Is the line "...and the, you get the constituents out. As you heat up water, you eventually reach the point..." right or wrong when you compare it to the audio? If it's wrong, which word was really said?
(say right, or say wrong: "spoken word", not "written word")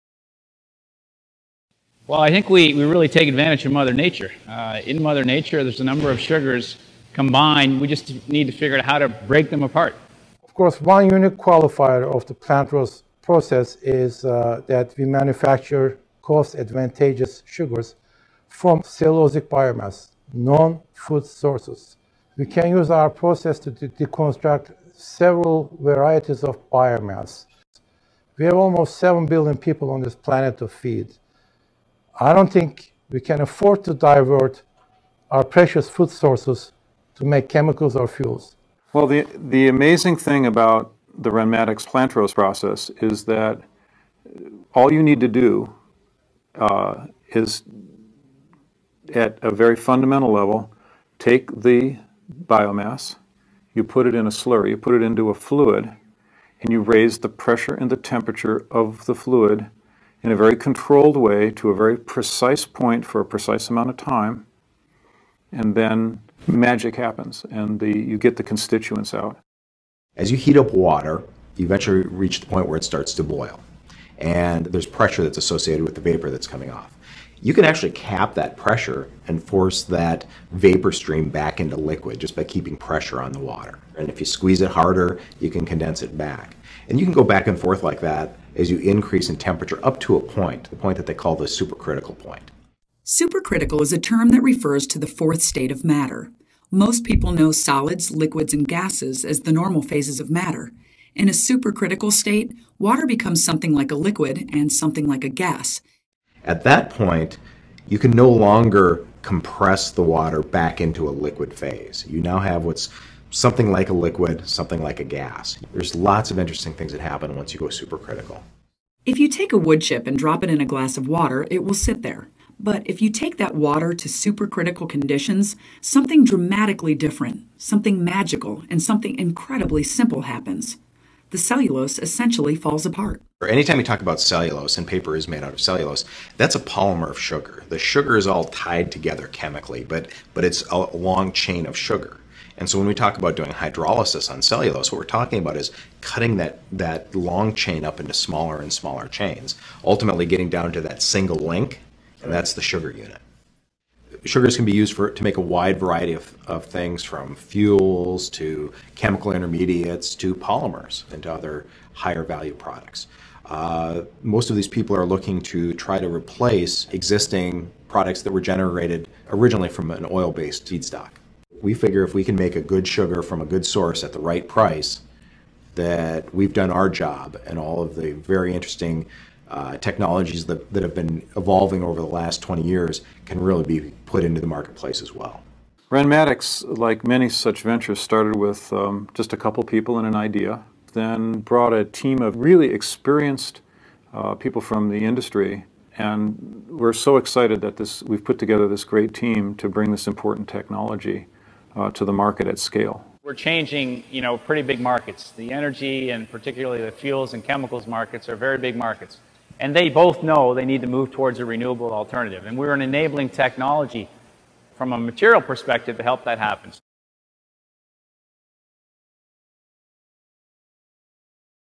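right.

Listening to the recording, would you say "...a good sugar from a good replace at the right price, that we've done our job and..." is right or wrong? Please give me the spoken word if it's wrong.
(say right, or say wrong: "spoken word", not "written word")
wrong: "source", not "replace".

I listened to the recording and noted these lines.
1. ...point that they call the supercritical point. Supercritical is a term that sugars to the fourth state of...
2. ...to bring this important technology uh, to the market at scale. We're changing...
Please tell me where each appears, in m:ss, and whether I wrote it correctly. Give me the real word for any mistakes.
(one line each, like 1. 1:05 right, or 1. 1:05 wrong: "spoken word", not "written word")
1. 1:30 wrong: "refers", not "sugars"
2. 3:19 right.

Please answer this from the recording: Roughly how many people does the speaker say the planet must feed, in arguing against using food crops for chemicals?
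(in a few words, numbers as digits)
7 billion.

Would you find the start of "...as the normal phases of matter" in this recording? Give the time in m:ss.
1:39.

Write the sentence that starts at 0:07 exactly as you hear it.
We just need to figure out how to break them apart.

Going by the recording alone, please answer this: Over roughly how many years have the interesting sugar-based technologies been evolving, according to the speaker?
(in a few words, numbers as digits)
20 years.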